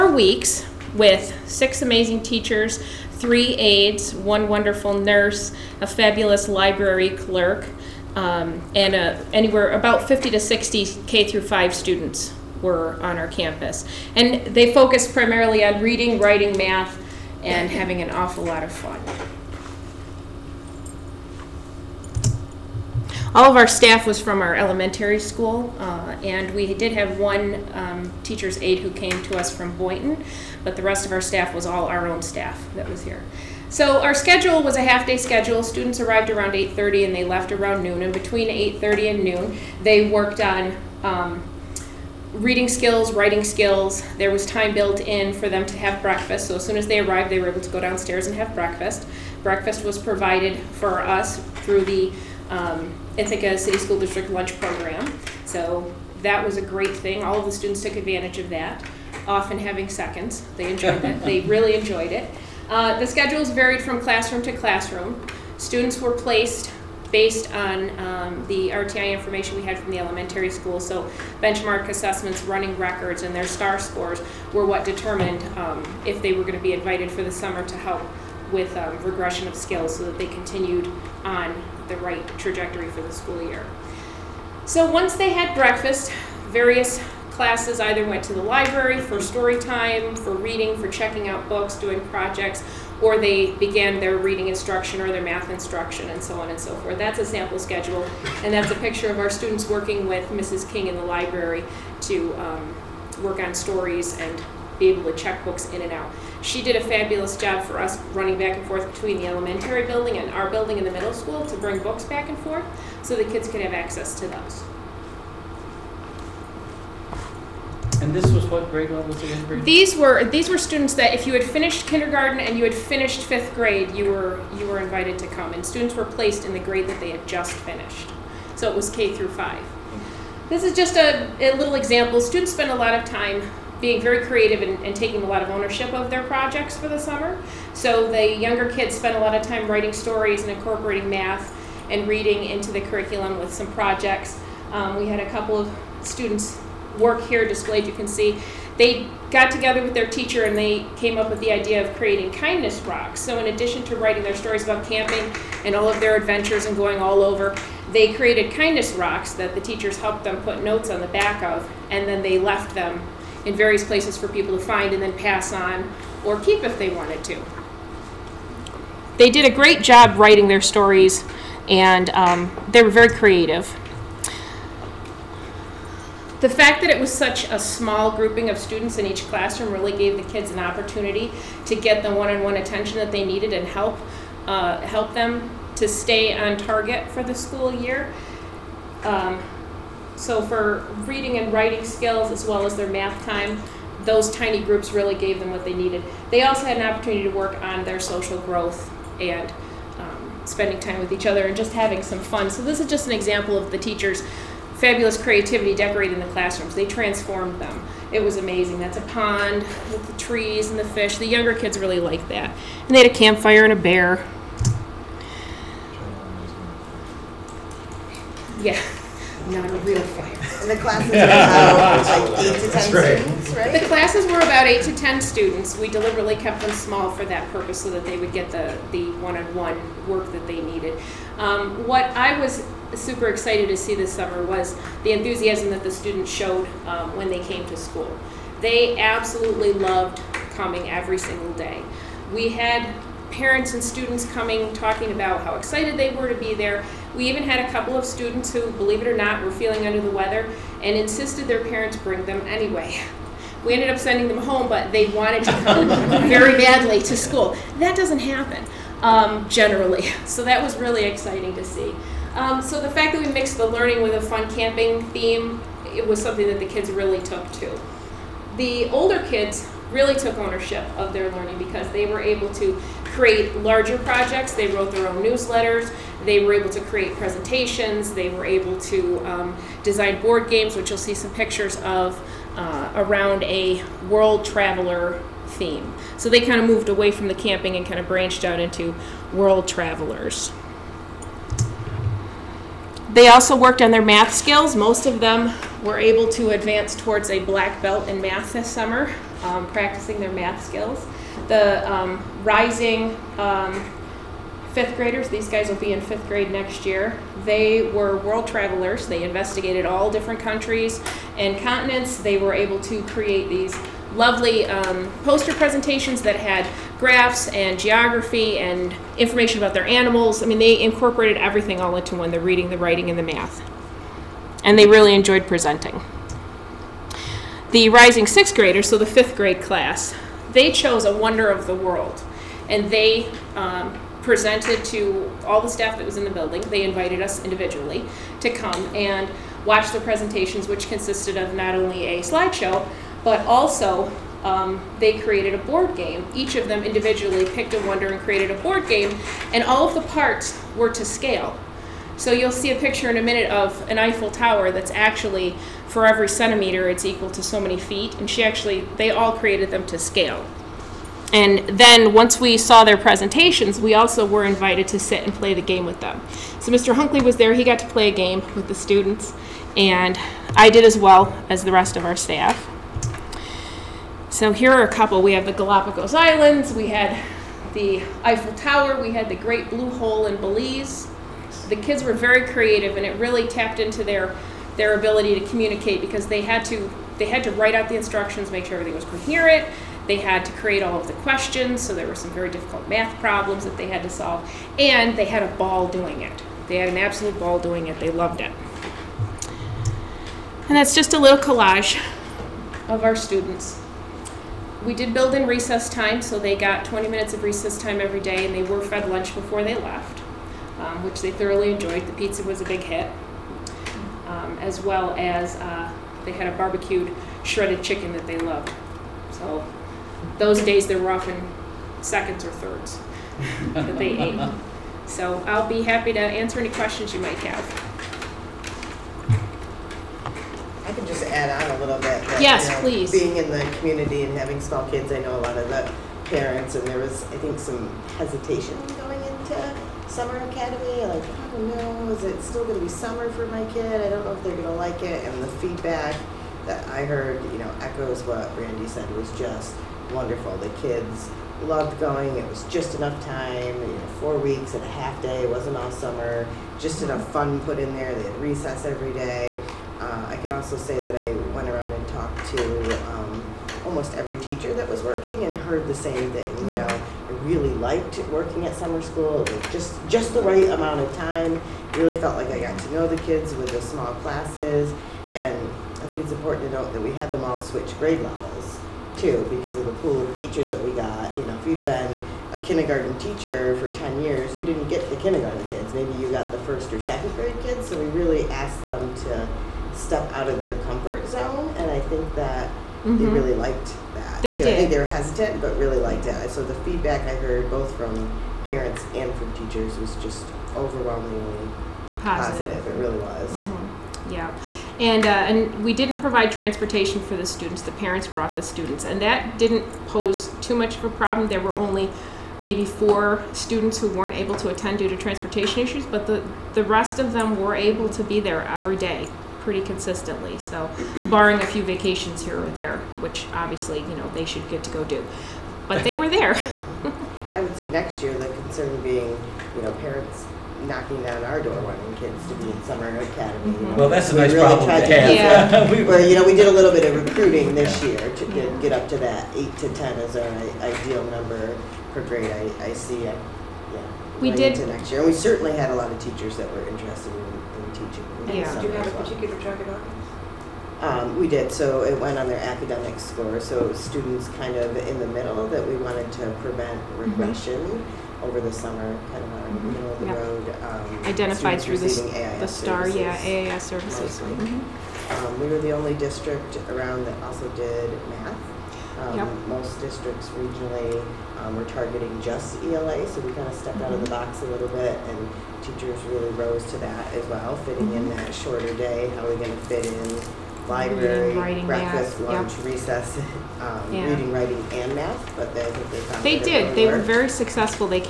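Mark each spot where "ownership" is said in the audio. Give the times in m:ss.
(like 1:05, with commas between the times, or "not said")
2:15, 4:30.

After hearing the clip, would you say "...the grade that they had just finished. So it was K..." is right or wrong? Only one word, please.
right.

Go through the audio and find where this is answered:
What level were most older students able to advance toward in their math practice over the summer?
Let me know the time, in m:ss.
4:57.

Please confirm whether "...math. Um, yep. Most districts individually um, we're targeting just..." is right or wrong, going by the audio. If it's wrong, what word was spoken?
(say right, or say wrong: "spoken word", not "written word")
wrong: "regionally", not "individually".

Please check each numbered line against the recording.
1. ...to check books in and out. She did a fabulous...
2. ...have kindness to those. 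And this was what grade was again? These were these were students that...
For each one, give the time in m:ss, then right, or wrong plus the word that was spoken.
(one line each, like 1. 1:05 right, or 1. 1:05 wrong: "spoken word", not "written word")
1. 1:45 right
2. 1:53 wrong: "access", not "kindness".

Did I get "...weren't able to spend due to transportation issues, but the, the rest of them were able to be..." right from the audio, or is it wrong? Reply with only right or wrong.
wrong.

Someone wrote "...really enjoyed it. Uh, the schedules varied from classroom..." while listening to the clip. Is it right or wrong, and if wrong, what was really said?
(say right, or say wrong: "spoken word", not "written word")
right.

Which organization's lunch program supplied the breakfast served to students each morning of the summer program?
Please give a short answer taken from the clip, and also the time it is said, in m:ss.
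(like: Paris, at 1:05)
Ithaca City School District, at 0:53.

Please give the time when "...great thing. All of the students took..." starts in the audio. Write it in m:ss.
0:56.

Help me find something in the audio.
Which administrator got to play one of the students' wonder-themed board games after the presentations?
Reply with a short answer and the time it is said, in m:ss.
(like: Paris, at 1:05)
Mr. Hunkley, at 6:06.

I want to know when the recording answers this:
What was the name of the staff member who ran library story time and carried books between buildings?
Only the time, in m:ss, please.
1:40.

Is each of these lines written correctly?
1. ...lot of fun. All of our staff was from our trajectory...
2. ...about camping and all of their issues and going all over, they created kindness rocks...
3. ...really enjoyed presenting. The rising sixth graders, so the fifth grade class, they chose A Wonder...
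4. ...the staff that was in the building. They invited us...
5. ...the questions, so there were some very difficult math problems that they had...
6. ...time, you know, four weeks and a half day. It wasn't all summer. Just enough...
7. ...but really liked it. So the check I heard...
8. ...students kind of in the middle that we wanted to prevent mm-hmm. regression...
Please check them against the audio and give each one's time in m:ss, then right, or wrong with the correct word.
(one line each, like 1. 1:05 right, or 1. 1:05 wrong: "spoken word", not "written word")
1. 0:18 wrong: "elementary", not "trajectory"
2. 2:34 wrong: "adventures", not "issues"
3. 5:24 right
4. 5:35 right
5. 6:31 right
6. 7:33 right
7. 8:15 wrong: "feedback", not "check"
8. 9:13 right.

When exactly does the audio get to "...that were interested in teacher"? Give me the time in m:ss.
9:06.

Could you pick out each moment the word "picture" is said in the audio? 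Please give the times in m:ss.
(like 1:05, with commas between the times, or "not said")
1:38, 4:41, 5:52.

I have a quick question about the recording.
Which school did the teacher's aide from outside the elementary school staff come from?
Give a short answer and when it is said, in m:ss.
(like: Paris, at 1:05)
Boynton, at 0:29.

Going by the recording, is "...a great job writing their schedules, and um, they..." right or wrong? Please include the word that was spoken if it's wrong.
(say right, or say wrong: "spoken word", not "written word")
wrong: "stories", not "schedules".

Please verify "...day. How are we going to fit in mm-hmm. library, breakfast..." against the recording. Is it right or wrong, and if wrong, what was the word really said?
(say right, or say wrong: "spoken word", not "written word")
right.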